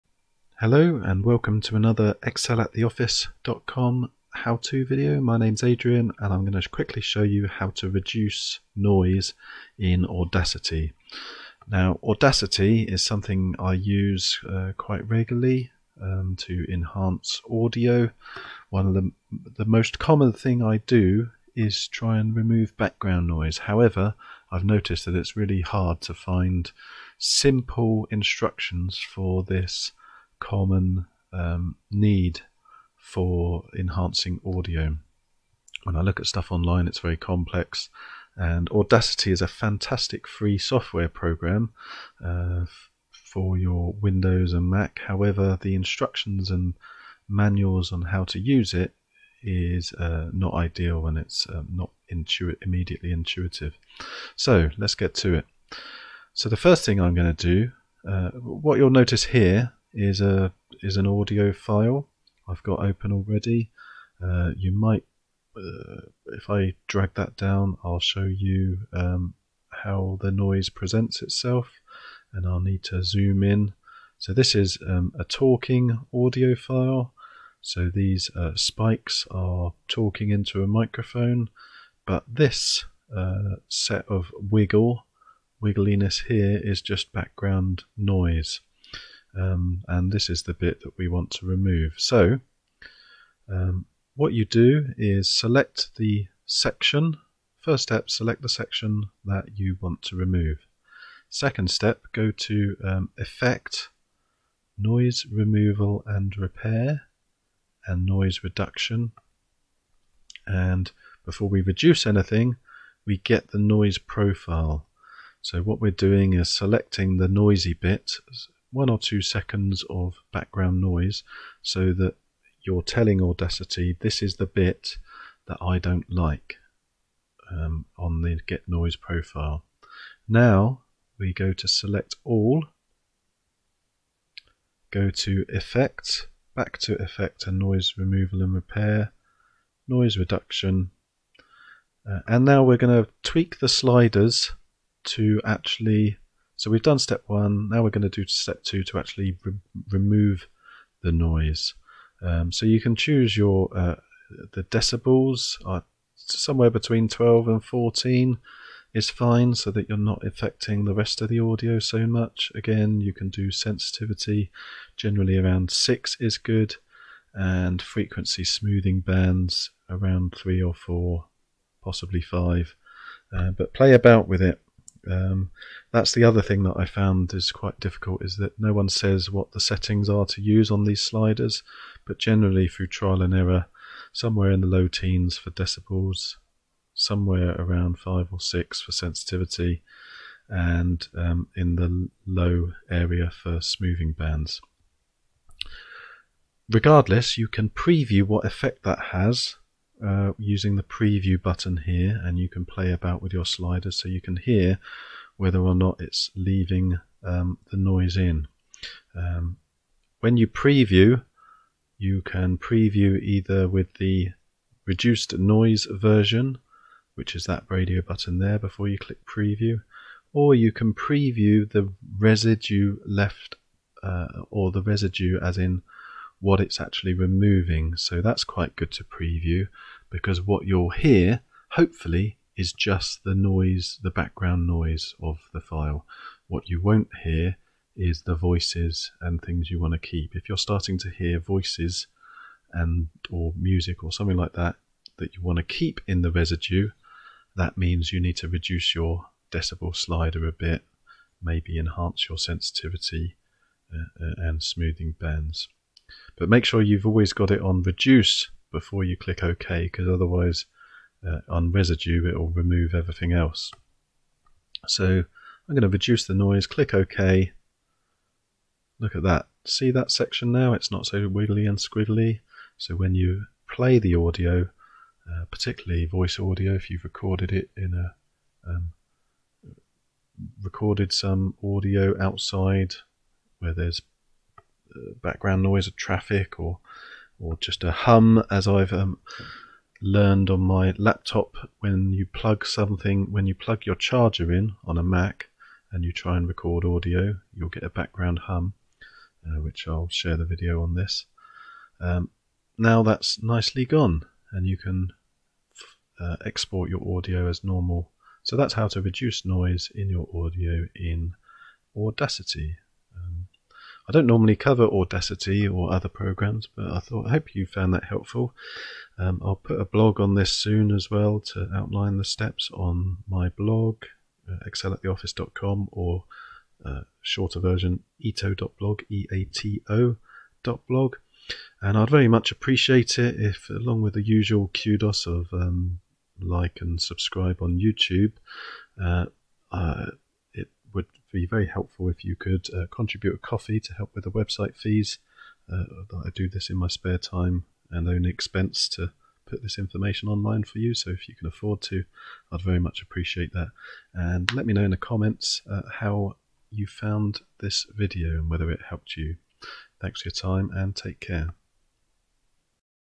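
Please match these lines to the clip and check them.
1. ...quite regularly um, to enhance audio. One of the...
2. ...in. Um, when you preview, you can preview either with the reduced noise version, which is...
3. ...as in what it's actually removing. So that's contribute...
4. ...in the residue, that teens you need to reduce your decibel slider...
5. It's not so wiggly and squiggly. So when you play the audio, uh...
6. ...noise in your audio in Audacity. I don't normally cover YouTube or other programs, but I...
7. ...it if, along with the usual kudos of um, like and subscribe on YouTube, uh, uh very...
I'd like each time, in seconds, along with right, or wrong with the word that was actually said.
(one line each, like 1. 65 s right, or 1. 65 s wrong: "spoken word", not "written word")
1. 14 s right
2. 208 s right
3. 225 s wrong: "quite", not "contribute"
4. 246 s wrong: "means", not "teens"
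5. 270 s right
6. 309 s wrong: "Audacity", not "YouTube"
7. 333 s right.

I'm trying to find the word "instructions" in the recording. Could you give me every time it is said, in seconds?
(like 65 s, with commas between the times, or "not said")
28 s, 45 s.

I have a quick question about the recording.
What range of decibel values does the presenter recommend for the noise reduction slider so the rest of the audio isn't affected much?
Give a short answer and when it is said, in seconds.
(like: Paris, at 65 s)
12 to 14, at 156 s.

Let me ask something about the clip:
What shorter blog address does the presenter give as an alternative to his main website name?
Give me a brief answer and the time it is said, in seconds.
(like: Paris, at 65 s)
eato.blog, at 328 s.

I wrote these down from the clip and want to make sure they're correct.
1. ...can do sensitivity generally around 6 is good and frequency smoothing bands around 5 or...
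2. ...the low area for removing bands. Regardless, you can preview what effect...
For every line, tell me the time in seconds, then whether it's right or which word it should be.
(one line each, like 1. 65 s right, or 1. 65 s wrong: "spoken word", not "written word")
1. 163 s wrong: "3", not "5"
2. 191 s wrong: "smoothing", not "removing".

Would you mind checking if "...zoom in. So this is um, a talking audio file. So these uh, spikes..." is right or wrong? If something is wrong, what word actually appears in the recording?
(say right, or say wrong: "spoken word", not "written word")
right.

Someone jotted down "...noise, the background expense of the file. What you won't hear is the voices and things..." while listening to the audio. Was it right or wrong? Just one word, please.
wrong.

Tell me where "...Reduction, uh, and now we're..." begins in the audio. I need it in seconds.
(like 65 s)
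140 s.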